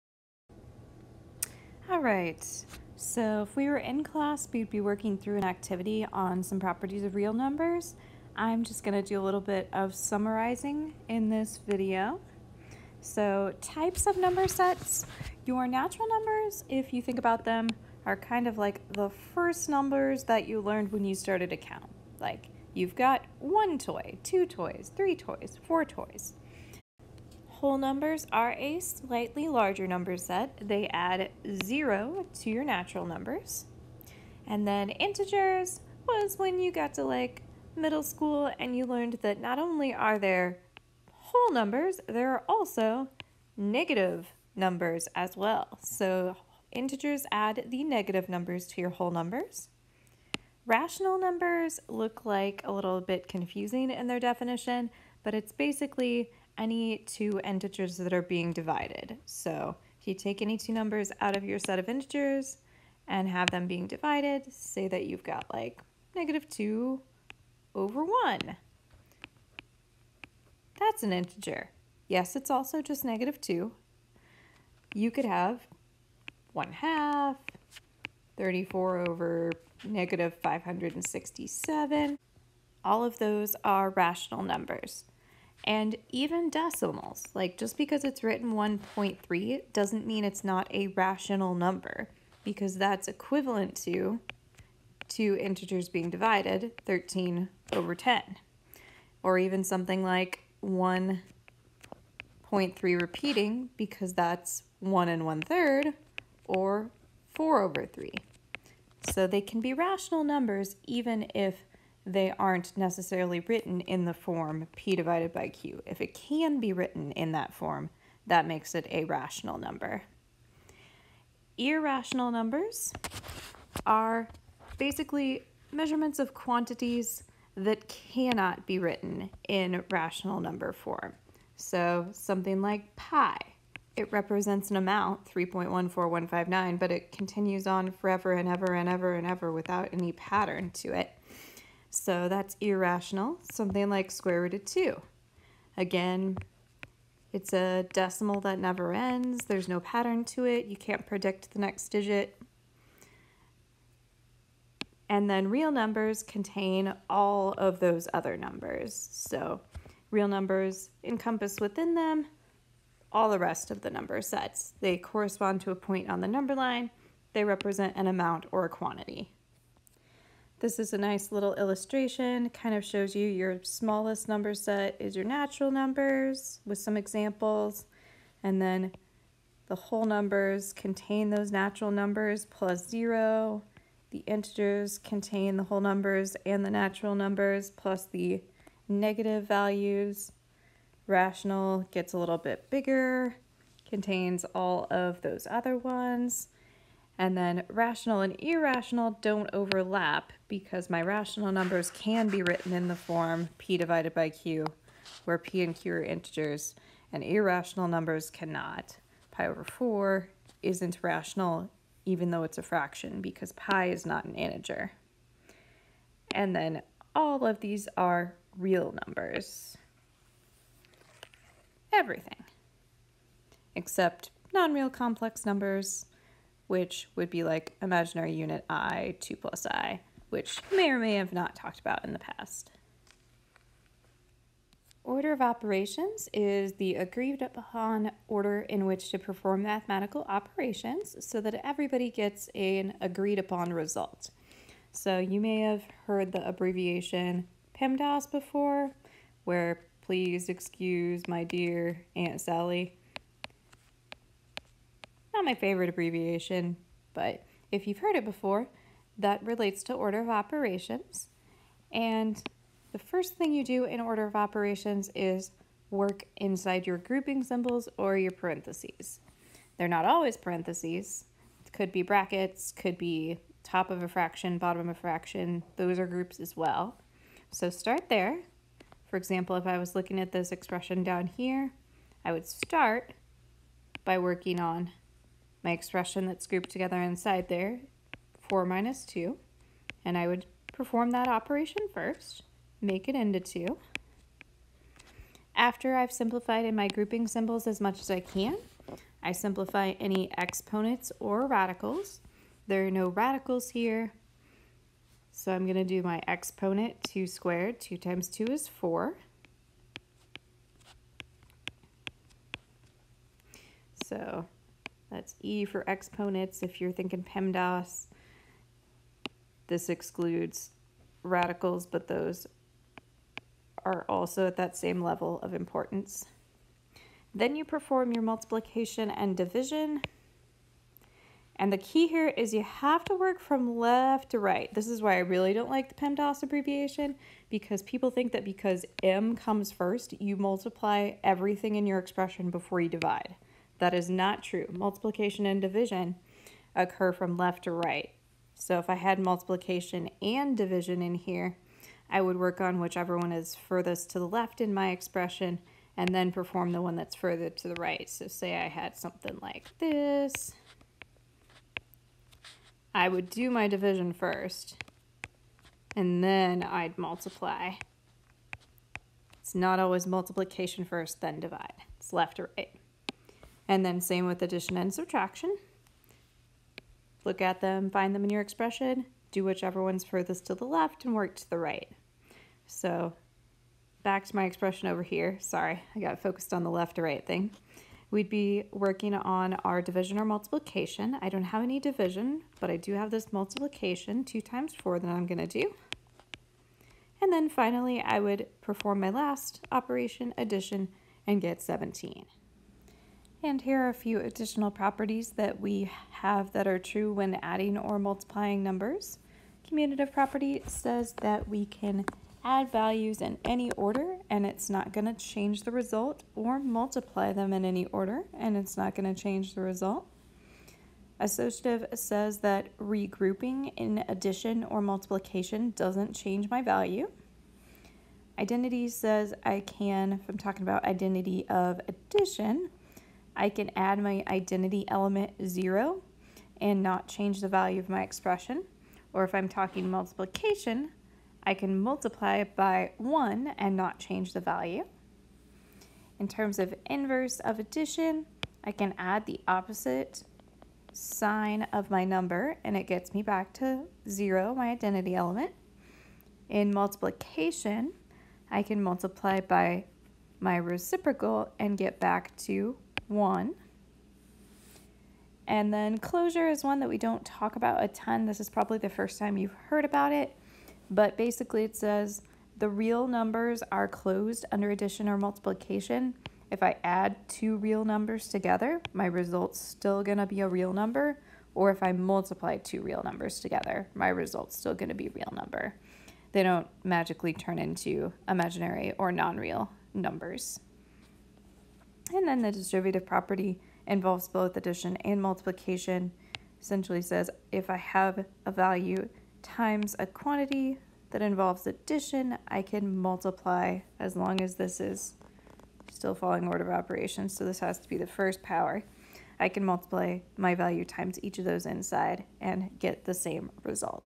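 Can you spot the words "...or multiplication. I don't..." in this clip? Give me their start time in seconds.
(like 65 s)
390 s.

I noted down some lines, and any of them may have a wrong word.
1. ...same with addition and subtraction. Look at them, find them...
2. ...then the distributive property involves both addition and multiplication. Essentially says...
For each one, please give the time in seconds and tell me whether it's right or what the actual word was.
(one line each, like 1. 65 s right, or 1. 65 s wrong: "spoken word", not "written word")
1. 374 s right
2. 492 s right.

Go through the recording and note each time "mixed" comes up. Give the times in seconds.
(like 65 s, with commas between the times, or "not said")
not said.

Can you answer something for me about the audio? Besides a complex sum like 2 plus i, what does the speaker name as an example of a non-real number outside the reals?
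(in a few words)
imaginary unit i.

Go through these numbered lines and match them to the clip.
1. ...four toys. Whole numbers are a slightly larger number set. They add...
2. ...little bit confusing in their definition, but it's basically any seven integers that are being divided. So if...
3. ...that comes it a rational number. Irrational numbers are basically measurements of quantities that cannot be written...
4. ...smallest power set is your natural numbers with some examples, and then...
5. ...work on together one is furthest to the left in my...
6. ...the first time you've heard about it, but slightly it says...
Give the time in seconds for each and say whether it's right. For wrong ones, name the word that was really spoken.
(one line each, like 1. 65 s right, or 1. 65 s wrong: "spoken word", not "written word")
1. 25 s right
2. 52 s wrong: "two", not "seven"
3. 118 s wrong: "makes", not "comes"
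4. 173 s wrong: "number", not "power"
5. 352 s wrong: "whichever", not "together"
6. 468 s wrong: "basically", not "slightly".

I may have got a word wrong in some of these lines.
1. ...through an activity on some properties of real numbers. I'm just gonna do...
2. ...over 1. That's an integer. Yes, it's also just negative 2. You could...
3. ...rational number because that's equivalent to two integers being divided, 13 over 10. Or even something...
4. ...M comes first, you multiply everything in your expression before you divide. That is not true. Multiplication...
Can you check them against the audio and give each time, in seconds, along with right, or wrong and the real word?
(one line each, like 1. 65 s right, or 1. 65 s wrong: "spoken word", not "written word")
1. 5 s right
2. 67 s right
3. 90 s right
4. 339 s right.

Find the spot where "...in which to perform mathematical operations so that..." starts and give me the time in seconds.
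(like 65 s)
238 s.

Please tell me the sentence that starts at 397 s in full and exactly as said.
And then finally, I would perform my last operation, addition, and get 17.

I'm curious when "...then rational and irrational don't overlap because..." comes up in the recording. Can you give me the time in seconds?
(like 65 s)
197 s.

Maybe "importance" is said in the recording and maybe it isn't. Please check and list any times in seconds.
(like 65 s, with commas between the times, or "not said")
325 s.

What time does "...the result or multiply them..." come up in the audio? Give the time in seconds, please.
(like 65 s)
415 s.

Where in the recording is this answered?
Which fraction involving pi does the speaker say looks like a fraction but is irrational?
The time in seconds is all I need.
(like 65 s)
209 s.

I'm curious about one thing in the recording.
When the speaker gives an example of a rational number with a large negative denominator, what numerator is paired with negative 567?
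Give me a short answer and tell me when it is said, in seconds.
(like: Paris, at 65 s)
34, at 78 s.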